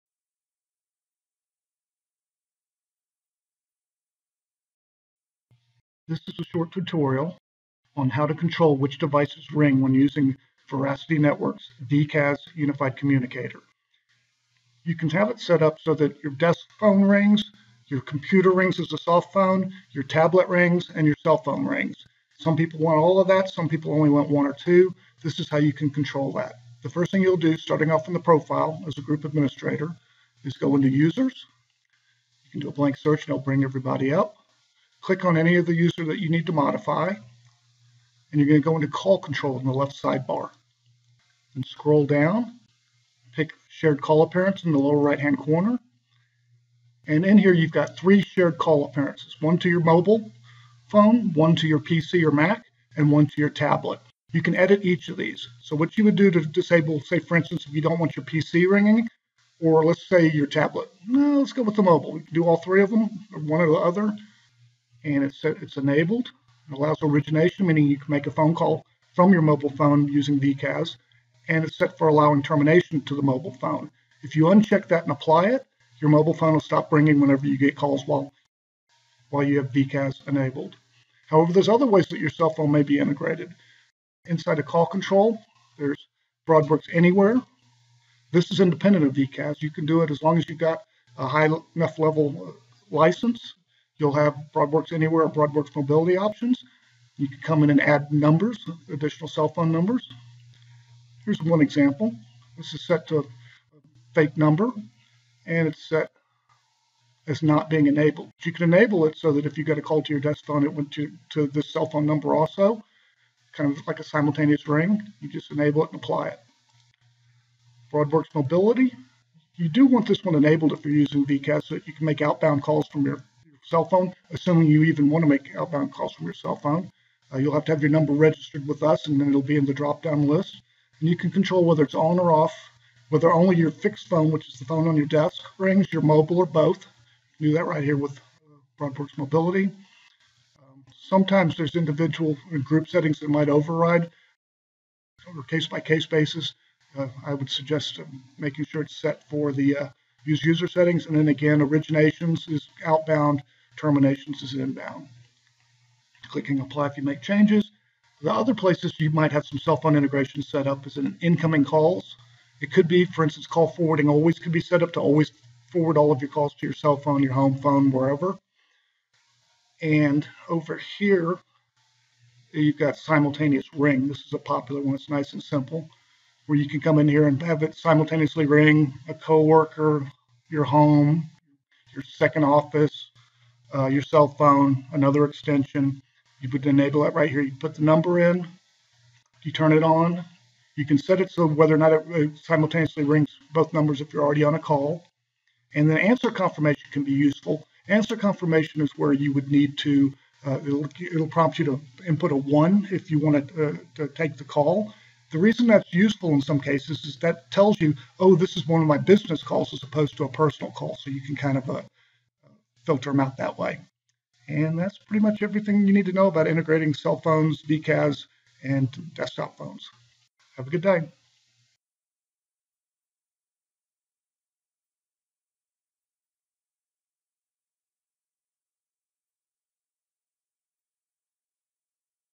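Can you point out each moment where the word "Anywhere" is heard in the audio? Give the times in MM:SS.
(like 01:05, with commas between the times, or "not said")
01:26, 01:34.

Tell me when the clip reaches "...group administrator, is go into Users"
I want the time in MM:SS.
00:29.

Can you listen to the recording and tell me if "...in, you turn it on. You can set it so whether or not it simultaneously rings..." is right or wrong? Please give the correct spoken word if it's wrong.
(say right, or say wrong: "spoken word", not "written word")
right.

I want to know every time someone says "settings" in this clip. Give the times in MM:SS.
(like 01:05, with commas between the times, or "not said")
02:22, 02:30.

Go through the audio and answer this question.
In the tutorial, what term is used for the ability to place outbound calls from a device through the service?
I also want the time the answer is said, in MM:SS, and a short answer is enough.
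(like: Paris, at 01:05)
Origination, at 01:07.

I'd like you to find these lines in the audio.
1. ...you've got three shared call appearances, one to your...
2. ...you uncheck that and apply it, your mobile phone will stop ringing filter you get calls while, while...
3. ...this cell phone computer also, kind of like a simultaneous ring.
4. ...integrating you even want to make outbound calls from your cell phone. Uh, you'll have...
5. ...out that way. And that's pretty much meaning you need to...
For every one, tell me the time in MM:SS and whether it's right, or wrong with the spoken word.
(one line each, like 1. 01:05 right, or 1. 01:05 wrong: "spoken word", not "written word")
1. 00:47 right
2. 01:14 wrong: "whenever", not "filter"
3. 01:51 wrong: "number", not "computer"
4. 02:04 wrong: "assuming", not "integrating"
5. 03:33 wrong: "everything", not "meaning".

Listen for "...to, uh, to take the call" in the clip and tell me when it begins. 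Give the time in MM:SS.
03:23.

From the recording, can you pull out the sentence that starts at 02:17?
You do that right here with BroadWorks uh, Mobility.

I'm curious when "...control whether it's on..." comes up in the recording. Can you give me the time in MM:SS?
02:11.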